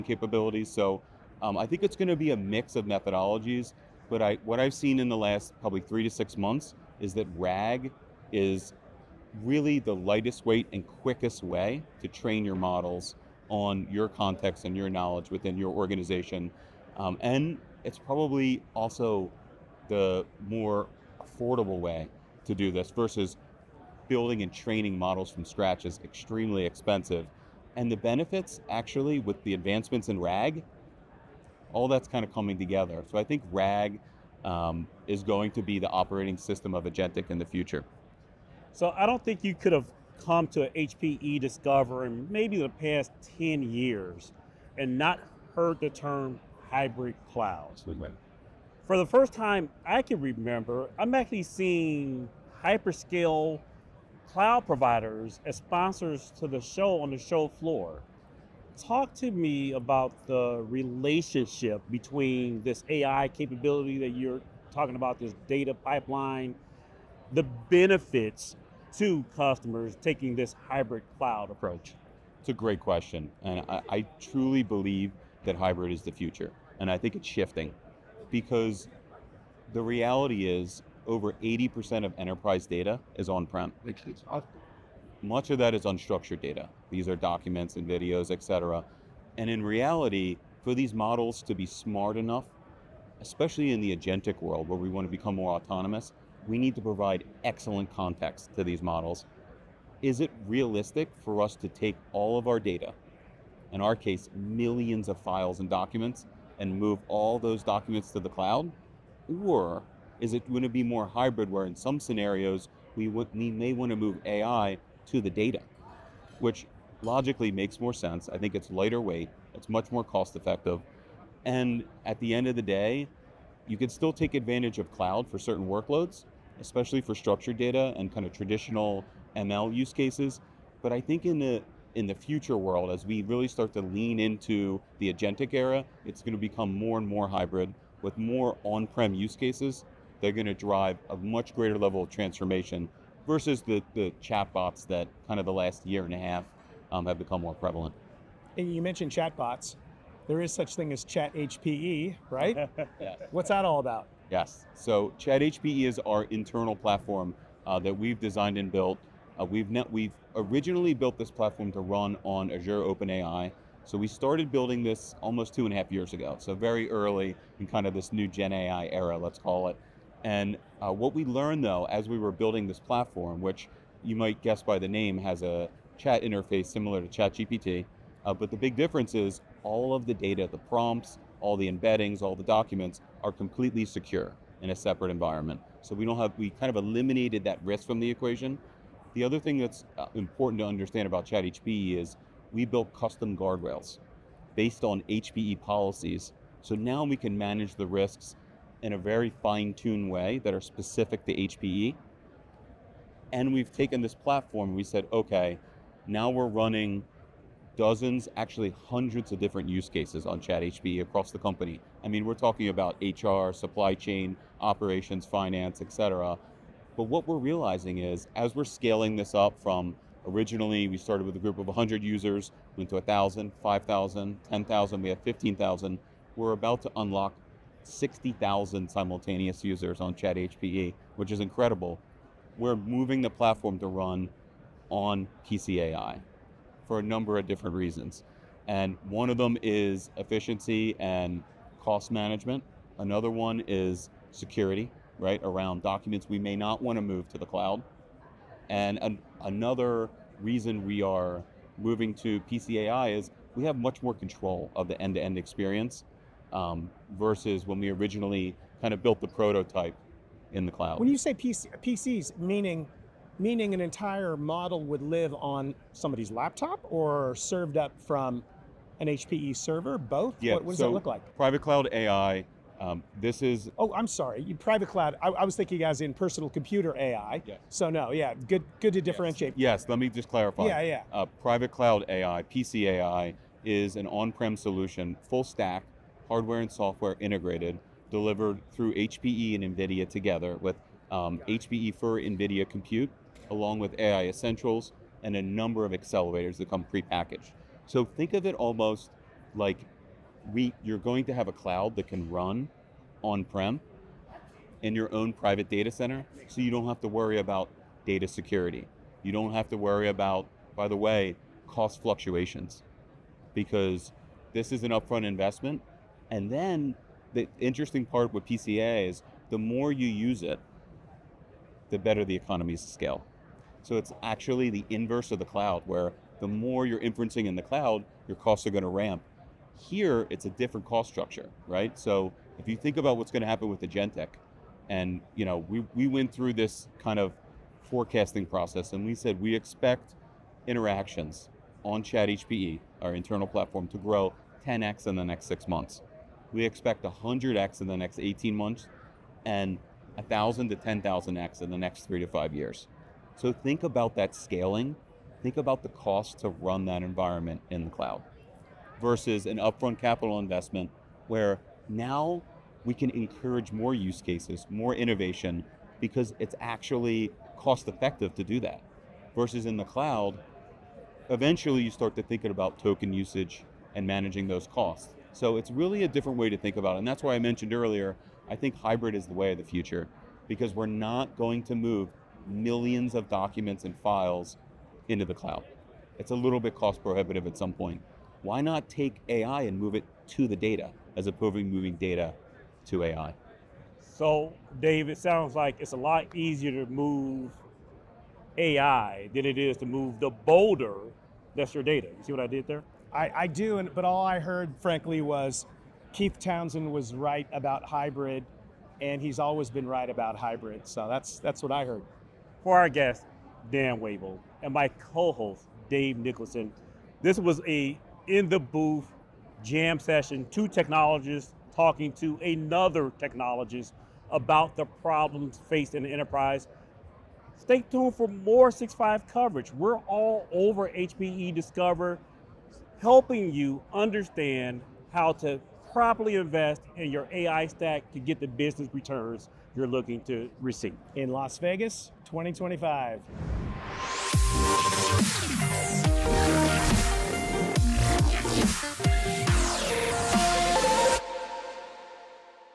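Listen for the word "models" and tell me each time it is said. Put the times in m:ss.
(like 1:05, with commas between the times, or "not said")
0:12, 0:24, 1:30, 1:38, 4:24.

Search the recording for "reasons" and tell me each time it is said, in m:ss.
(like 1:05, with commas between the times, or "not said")
3:57, 4:10.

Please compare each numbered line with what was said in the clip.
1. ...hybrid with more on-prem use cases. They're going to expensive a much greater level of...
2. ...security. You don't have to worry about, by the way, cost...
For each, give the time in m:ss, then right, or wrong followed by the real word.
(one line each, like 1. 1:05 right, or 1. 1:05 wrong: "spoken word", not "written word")
1. 2:17 wrong: "drive", not "expensive"
2. 5:08 right.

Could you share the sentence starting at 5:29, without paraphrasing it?
Here, it's a different cost structure, right?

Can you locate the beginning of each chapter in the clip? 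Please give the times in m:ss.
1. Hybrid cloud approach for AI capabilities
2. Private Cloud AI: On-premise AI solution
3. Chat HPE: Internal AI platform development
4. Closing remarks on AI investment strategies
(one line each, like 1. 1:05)
1. 1:12
2. 4:39
3. 2:34
4. 6:52.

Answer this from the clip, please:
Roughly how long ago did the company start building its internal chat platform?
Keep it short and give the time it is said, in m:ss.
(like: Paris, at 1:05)
two and a half years, at 2:45.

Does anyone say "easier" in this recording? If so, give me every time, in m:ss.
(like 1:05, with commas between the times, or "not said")
6:36.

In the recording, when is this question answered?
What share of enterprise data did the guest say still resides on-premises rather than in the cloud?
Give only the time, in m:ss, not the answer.
1:21.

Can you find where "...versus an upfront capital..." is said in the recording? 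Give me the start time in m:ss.
5:58.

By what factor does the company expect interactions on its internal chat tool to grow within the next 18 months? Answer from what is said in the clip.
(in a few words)
100x.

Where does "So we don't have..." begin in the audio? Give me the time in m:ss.
3:05.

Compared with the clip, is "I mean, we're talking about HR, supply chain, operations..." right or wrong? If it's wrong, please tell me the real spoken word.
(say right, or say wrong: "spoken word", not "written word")
right.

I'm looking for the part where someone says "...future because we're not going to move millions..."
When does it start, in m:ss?
6:19.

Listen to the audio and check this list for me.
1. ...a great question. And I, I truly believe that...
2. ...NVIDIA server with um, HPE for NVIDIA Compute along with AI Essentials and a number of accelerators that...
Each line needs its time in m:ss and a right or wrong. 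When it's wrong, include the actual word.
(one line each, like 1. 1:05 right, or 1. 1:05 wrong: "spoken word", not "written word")
1. 1:12 right
2. 4:49 wrong: "together", not "server".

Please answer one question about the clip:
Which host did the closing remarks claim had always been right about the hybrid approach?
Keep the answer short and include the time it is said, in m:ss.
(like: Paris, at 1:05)
Keith Townsend, at 6:46.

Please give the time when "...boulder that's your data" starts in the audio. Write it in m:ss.
6:40.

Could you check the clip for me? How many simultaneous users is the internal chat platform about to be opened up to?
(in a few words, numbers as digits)
60,000.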